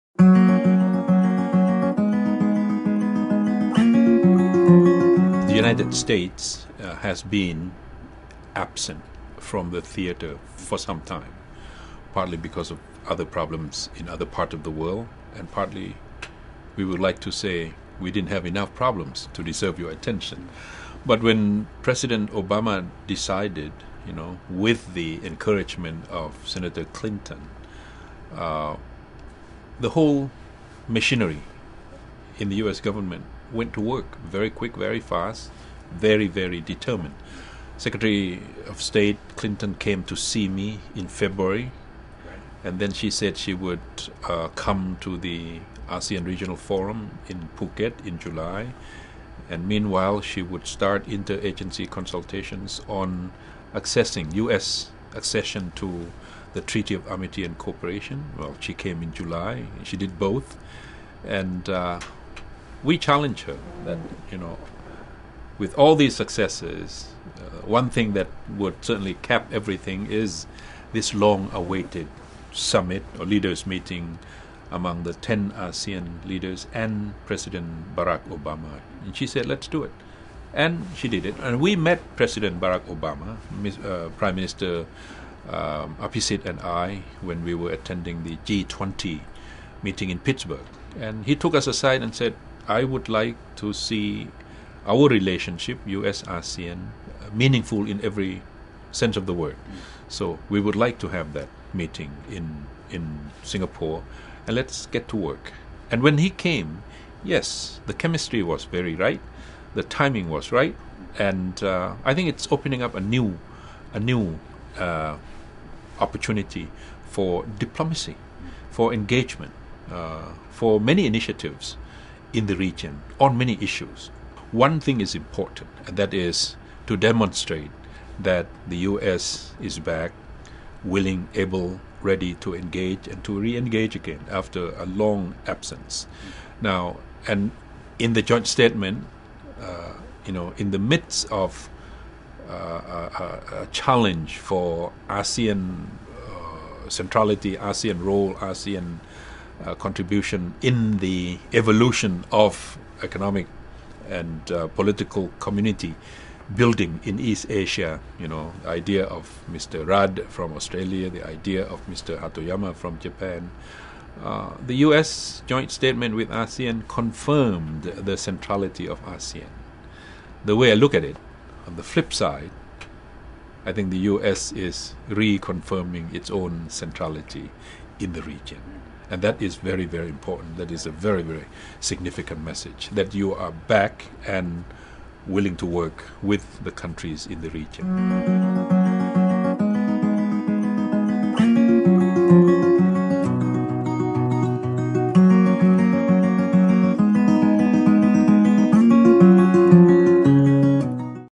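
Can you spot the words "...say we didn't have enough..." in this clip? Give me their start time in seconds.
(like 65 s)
17 s.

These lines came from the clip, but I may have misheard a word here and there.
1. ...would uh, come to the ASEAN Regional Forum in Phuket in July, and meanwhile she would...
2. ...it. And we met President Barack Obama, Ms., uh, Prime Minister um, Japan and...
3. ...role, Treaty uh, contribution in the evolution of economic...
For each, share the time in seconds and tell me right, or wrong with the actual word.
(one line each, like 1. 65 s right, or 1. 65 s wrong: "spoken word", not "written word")
1. 43 s right
2. 81 s wrong: "Abhisit", not "Japan"
3. 148 s wrong: "ASEAN", not "Treaty".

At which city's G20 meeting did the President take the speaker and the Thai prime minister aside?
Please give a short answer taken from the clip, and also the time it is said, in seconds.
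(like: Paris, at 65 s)
Pittsburgh, at 90 s.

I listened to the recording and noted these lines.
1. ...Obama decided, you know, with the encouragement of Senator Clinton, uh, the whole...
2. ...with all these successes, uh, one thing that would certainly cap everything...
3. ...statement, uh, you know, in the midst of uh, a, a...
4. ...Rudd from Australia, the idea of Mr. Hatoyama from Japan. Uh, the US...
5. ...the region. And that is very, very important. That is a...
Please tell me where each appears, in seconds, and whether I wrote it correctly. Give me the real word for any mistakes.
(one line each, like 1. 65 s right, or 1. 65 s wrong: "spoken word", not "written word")
1. 22 s right
2. 65 s right
3. 138 s right
4. 159 s right
5. 178 s right.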